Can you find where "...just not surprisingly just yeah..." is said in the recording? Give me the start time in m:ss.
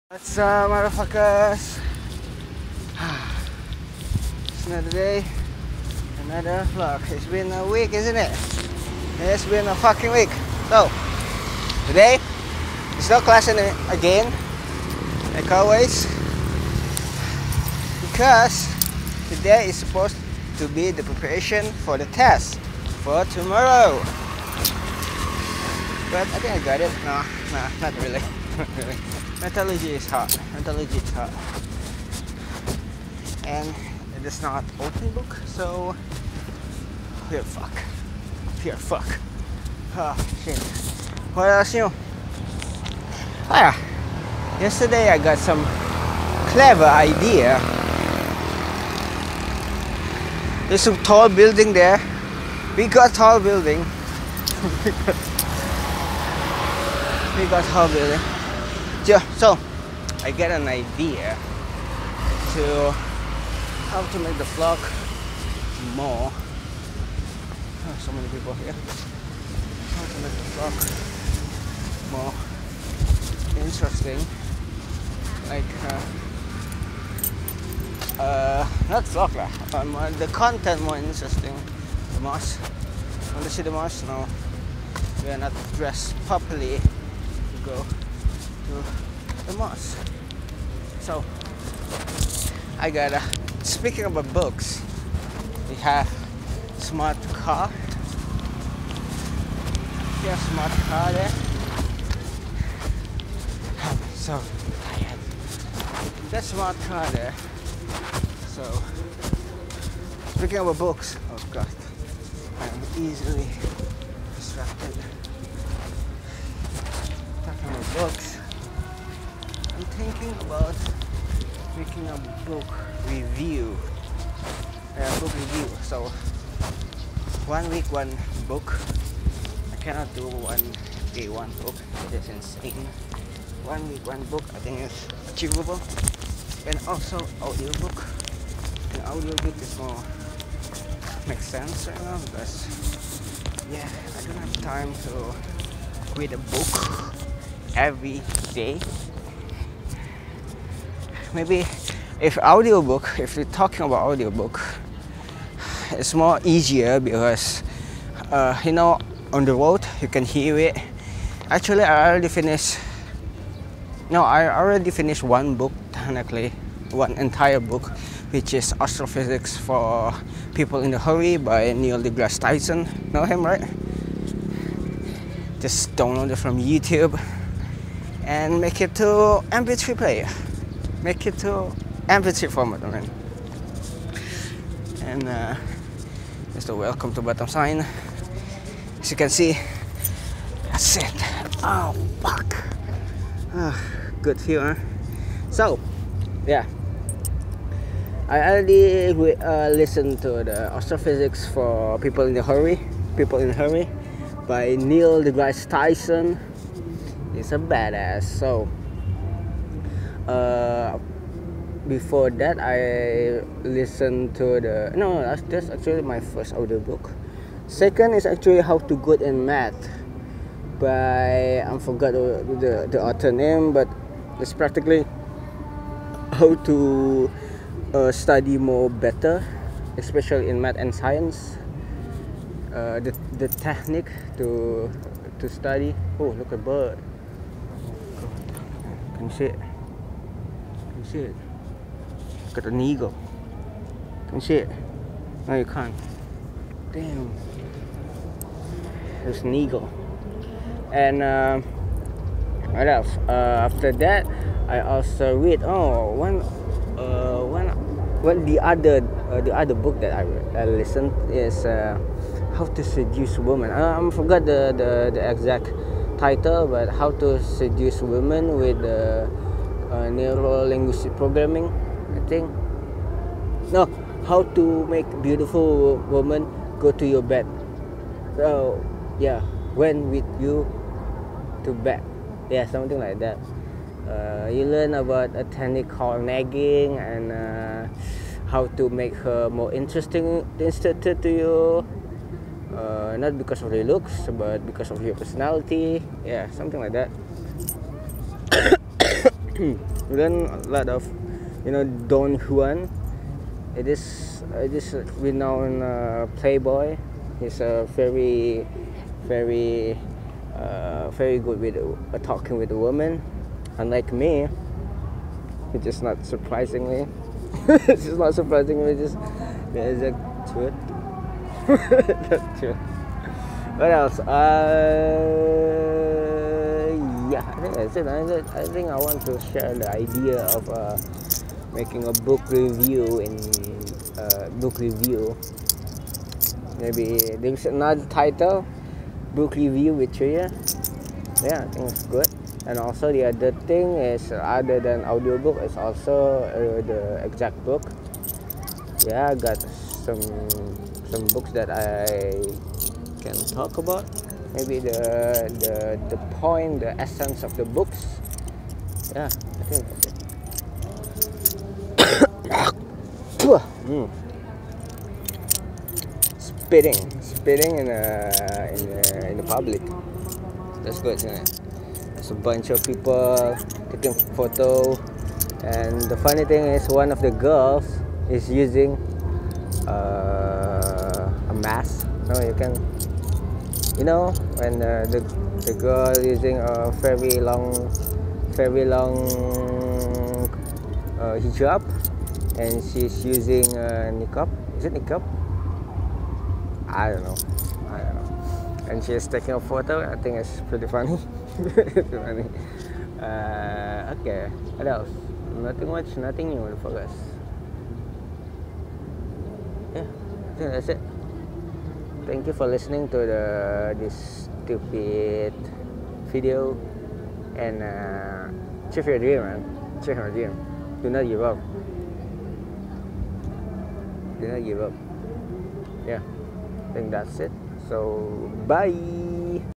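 5:18.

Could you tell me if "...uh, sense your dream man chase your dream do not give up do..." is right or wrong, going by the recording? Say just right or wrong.
wrong.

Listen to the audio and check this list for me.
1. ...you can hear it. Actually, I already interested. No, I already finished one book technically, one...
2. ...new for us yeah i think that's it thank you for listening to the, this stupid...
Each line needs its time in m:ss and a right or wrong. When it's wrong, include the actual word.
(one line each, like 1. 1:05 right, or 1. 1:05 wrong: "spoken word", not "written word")
1. 2:40 wrong: "finished", not "interested"
2. 6:46 right.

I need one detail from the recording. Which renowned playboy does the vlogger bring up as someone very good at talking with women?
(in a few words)
Don Juan.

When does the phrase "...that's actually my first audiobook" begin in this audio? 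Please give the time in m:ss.
3:35.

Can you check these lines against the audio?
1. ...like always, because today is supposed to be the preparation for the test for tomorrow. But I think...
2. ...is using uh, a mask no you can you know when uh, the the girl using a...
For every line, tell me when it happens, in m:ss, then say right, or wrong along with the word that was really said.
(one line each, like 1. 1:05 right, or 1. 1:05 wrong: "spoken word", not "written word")
1. 0:15 right
2. 6:18 right.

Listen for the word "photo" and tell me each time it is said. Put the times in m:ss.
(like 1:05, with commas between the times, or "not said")
6:14, 6:39.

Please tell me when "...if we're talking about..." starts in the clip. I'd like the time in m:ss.
2:33.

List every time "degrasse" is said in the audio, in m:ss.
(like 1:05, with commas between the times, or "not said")
2:52, 3:25.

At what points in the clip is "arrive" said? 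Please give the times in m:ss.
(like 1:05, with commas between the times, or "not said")
not said.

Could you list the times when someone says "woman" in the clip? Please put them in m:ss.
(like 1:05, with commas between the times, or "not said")
4:36, 5:12.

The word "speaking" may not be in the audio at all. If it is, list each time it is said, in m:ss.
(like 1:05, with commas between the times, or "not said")
1:33, 1:50.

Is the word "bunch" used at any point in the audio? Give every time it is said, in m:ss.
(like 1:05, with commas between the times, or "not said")
6:12.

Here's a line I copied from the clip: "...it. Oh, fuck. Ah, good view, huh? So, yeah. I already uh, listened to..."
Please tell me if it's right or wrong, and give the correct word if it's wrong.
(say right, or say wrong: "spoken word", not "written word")
right.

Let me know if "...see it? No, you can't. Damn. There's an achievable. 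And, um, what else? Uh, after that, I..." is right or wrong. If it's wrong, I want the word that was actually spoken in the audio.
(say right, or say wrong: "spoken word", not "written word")
wrong: "eagle", not "achievable".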